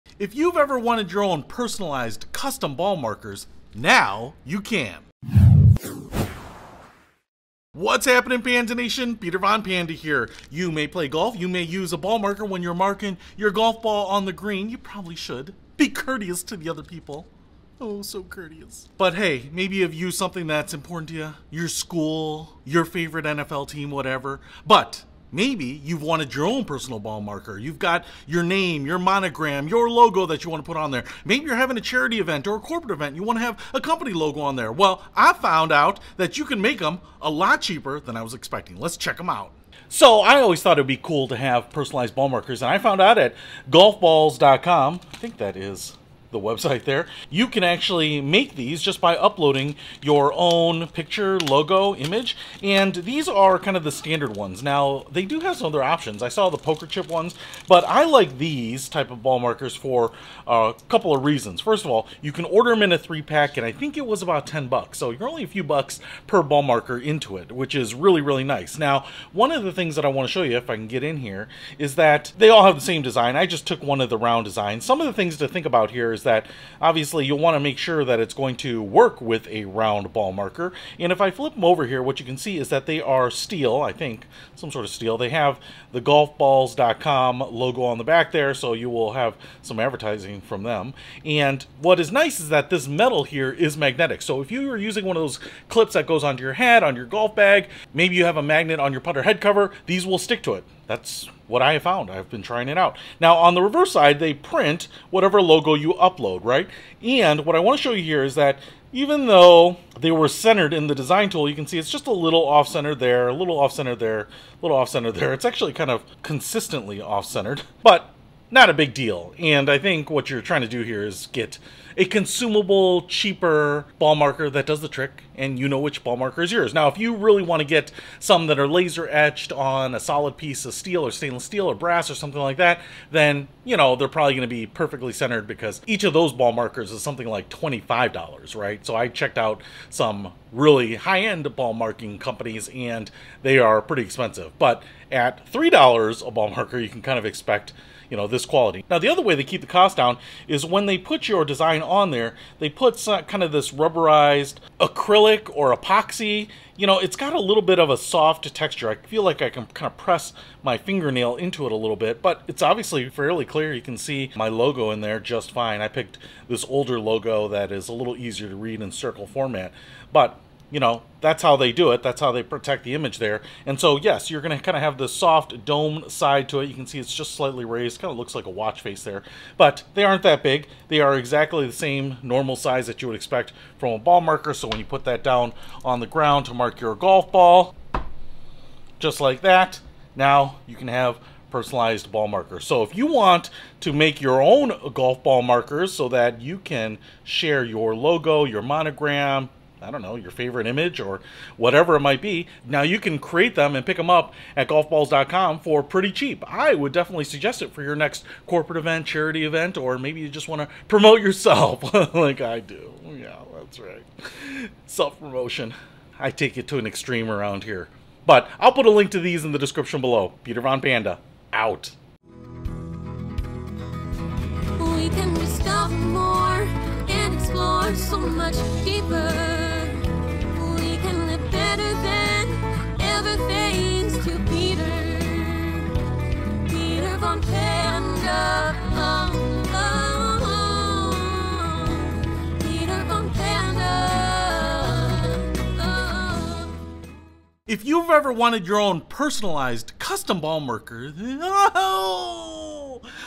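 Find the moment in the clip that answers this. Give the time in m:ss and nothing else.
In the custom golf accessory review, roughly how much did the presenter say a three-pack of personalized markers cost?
1:04.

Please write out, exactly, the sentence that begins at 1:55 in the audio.
It's actually kind of consistently off-centered, but not a big deal.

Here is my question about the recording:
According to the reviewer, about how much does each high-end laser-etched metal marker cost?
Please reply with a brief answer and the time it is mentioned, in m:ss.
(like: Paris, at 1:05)
$25, at 2:17.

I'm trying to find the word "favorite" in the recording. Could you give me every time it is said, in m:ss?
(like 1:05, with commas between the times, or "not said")
0:22, 3:20.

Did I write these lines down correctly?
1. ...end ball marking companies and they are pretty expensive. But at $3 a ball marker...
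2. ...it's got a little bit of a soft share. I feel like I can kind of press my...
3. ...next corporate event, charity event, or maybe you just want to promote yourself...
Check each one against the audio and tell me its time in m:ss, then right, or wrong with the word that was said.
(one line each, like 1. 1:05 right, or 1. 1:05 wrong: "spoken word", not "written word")
1. 2:21 right
2. 2:36 wrong: "texture", not "share"
3. 3:27 right.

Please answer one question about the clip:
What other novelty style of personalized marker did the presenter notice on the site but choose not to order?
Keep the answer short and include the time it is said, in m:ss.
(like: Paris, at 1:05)
poker chip, at 0:56.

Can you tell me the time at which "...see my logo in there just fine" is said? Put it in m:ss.
2:43.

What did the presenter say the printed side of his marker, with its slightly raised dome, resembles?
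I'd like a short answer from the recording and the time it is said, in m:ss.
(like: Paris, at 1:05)
a watch face, at 2:58.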